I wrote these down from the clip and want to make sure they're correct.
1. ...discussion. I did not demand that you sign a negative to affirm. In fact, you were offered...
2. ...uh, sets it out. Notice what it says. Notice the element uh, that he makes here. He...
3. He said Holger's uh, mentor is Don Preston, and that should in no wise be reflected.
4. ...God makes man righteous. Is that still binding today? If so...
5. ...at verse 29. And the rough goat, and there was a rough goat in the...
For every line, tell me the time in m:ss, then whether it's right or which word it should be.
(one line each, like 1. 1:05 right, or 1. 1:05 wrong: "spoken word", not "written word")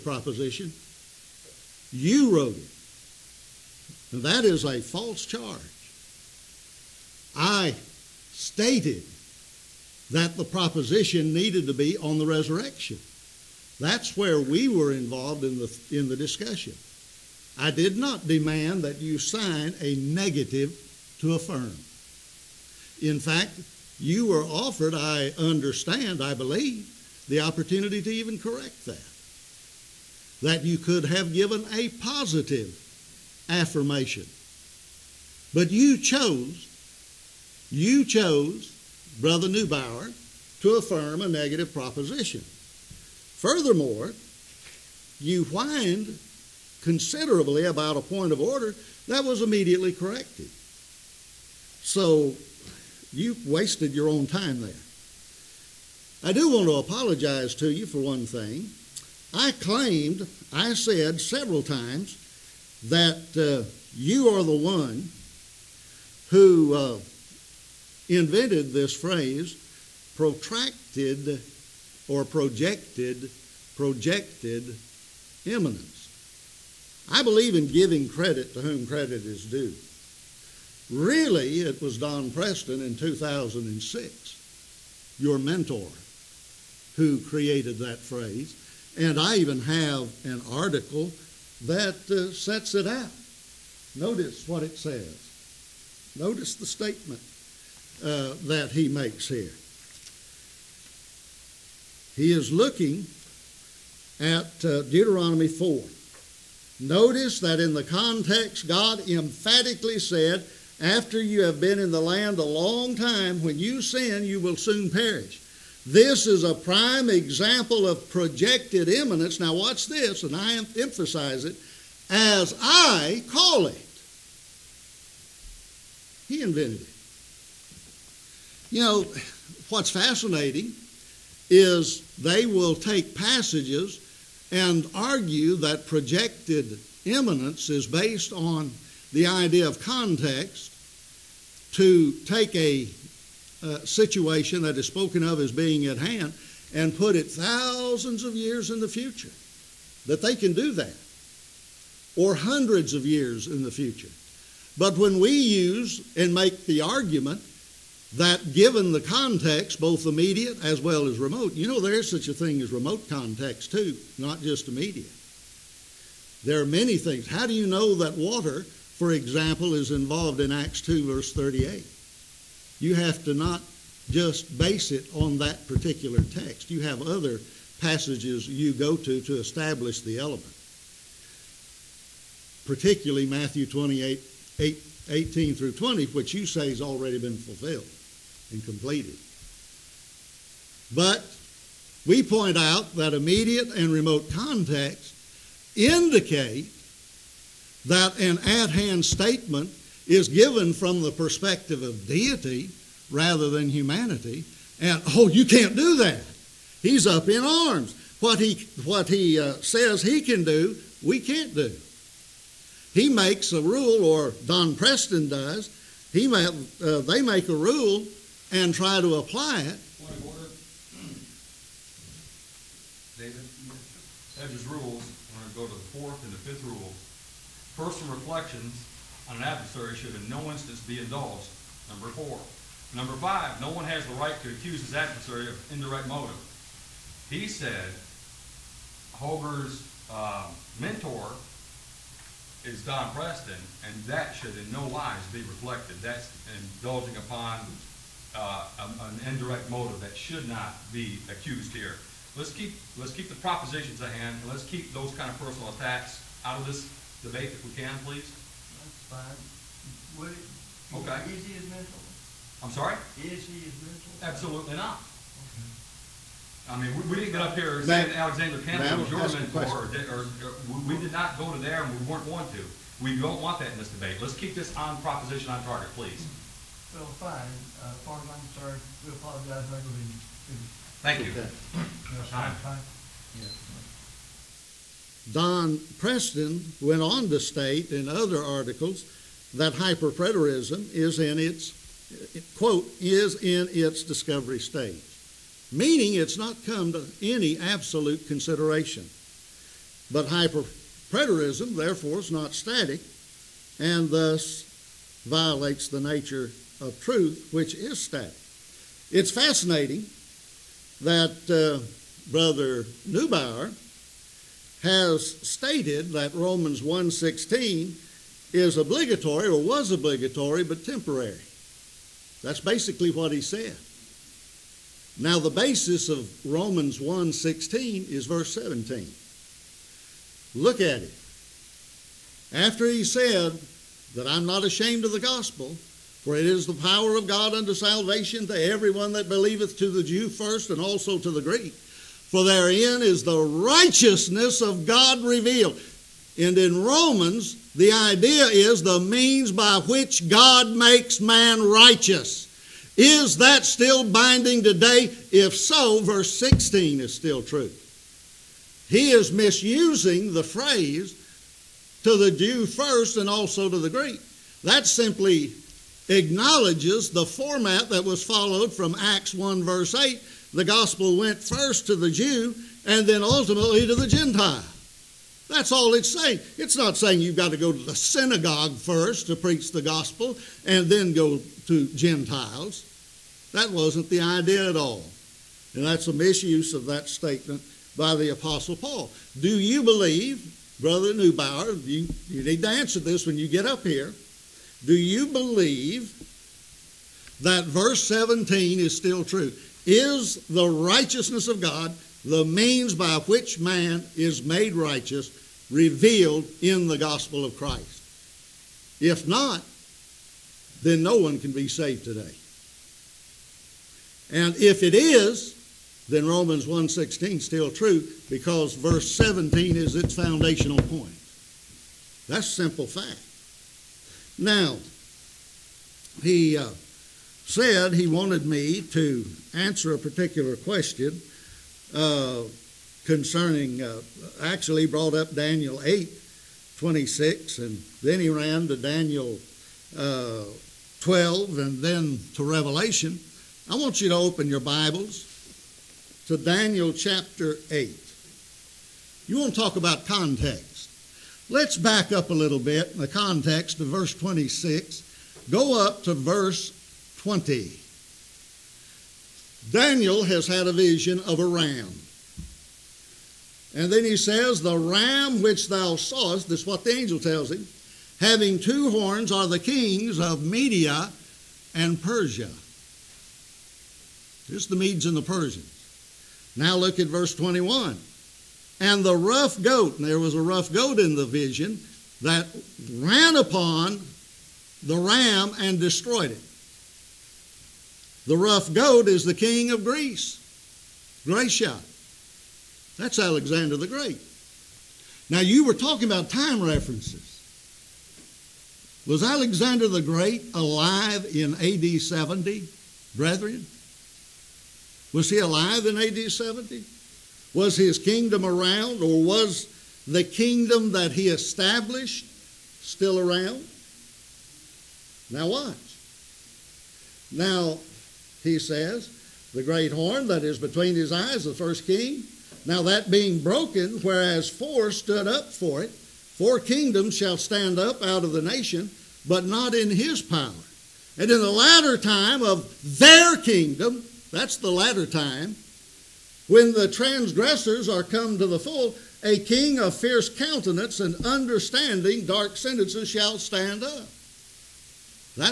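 1. 0:16 right
2. 1:32 wrong: "statement", not "element"
3. 3:57 right
4. 5:50 right
5. 7:56 wrong: "21", not "29".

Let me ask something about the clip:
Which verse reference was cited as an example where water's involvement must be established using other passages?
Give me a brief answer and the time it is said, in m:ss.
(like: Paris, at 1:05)
Acts 2:38, at 2:50.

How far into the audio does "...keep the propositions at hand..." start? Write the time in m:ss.
4:13.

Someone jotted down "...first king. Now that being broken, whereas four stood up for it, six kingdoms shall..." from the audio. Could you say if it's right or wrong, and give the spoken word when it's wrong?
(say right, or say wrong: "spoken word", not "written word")
wrong: "four", not "six".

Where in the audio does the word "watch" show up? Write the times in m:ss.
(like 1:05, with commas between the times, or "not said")
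1:59, 8:35.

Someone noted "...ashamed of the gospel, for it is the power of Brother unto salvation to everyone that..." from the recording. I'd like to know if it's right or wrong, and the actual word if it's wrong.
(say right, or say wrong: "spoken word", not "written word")
wrong: "God", not "Brother".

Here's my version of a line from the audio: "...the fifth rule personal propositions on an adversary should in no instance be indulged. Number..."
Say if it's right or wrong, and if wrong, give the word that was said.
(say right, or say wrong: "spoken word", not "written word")
wrong: "reflections", not "propositions".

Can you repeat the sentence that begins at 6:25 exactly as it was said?
And that's a misuse of that statement by the Apostle Paul.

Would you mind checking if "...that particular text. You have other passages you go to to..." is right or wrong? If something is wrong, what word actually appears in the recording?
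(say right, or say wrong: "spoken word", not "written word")
right.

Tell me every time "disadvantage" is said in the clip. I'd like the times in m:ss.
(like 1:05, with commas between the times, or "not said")
not said.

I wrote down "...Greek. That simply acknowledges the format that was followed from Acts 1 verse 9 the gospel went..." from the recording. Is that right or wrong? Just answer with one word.
wrong.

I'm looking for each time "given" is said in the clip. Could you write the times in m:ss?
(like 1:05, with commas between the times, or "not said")
0:31, 2:38, 3:20.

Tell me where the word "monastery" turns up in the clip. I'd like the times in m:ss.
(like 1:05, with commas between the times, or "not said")
not said.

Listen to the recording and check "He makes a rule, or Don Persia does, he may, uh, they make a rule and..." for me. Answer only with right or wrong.
wrong.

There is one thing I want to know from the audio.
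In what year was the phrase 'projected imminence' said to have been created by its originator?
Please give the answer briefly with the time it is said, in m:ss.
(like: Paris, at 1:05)
2006, at 1:22.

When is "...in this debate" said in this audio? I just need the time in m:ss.
4:33.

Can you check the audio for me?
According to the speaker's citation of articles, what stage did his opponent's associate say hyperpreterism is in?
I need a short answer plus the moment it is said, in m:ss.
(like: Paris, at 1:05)
discovery stage, at 4:54.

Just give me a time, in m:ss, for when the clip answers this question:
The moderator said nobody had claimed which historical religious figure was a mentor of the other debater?
4:28.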